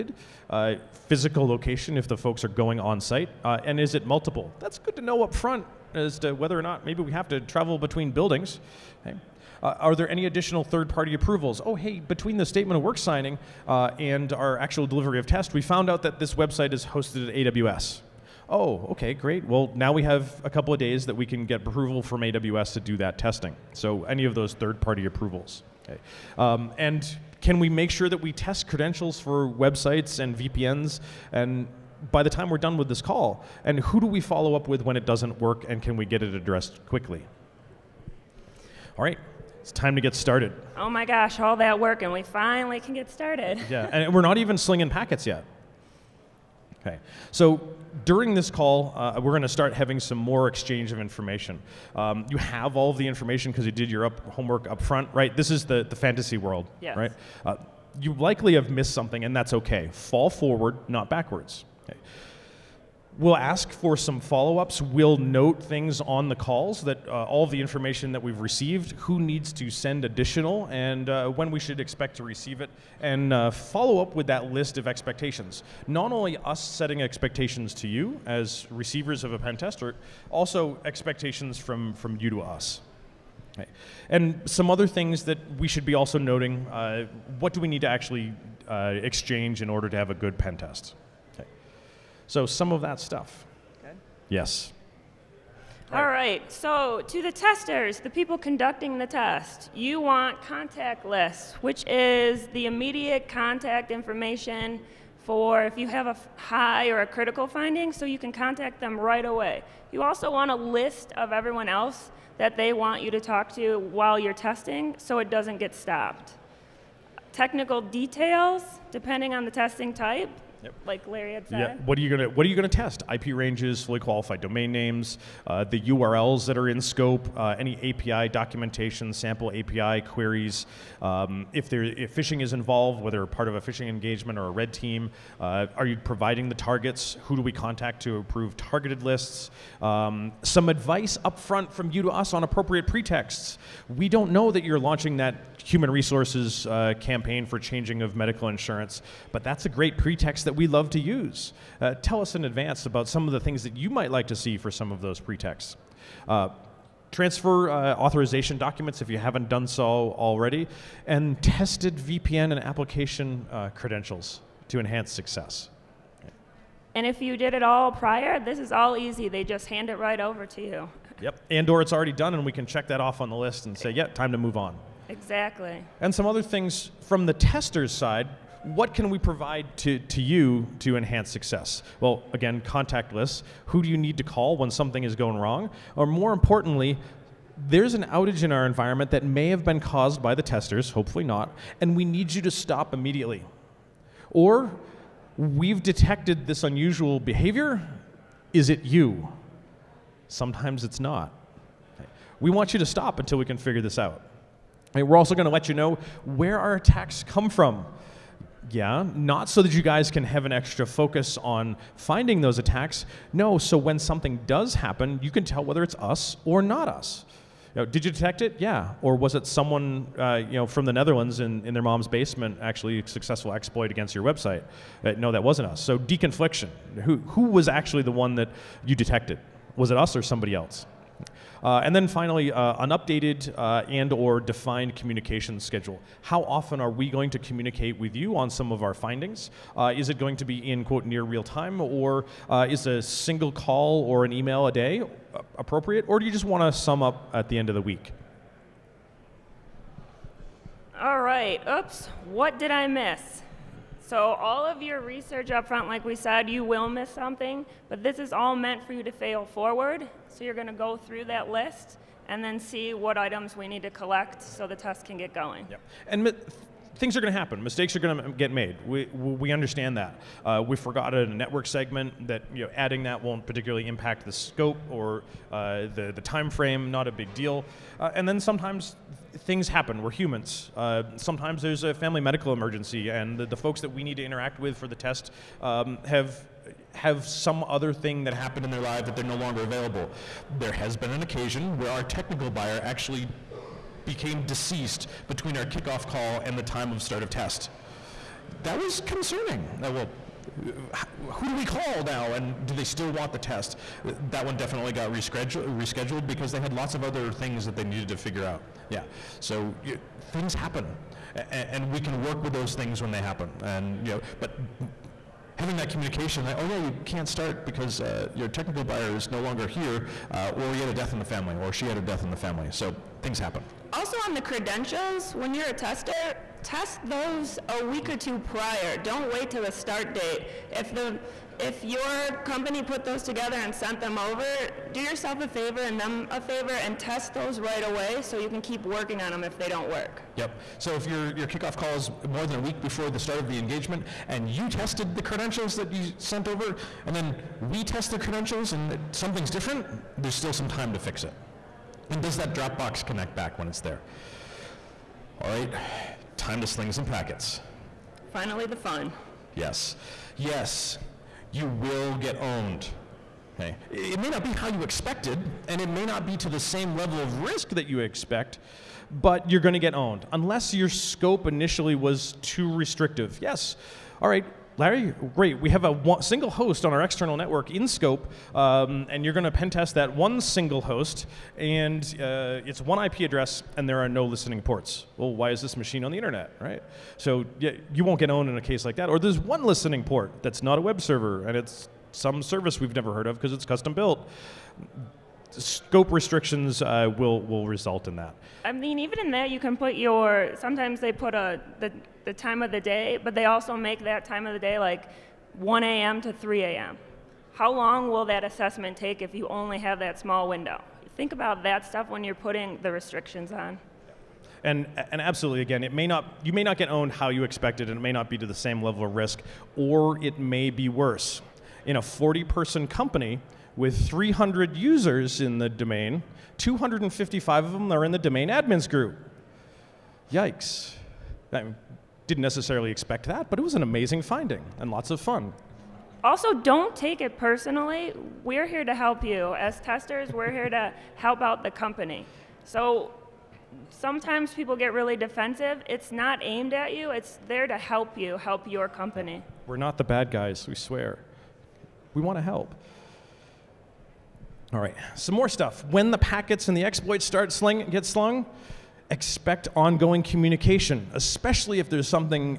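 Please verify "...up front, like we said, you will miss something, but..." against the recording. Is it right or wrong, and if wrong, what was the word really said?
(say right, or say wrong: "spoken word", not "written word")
right.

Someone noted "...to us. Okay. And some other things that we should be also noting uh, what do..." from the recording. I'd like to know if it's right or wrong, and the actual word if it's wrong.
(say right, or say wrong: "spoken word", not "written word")
right.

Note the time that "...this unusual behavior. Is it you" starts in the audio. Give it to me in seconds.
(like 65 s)
196 s.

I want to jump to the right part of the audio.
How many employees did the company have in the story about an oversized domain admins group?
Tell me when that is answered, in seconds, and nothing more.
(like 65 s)
421 s.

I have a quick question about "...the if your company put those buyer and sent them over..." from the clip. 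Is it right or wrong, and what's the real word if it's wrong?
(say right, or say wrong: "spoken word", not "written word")
wrong: "together", not "buyer".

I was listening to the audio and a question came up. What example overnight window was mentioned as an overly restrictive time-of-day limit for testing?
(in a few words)
1 a.m. to 3 a.m.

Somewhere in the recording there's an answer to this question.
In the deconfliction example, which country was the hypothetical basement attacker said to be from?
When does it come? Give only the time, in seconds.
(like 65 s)
220 s.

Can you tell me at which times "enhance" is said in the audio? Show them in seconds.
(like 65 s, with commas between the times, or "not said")
164 s, 180 s.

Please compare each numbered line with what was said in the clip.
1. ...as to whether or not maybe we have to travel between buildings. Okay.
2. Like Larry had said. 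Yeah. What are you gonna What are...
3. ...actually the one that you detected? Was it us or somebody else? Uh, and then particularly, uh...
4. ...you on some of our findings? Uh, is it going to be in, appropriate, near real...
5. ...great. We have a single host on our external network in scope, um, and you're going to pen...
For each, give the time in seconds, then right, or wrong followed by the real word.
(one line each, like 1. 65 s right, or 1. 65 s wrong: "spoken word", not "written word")
1. 5 s right
2. 120 s right
3. 227 s wrong: "finally", not "particularly"
4. 238 s wrong: "quote", not "appropriate"
5. 375 s right.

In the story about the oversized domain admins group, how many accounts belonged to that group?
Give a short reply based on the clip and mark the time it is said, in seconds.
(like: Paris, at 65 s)
255, at 426 s.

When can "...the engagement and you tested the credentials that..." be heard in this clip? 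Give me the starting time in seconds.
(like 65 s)
343 s.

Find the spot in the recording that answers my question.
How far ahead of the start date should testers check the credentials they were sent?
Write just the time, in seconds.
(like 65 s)
327 s.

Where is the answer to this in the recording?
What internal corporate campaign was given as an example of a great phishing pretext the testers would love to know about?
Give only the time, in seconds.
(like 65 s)
147 s.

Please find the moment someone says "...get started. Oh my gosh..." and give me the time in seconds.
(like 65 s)
40 s.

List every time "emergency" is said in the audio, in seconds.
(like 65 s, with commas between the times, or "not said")
282 s.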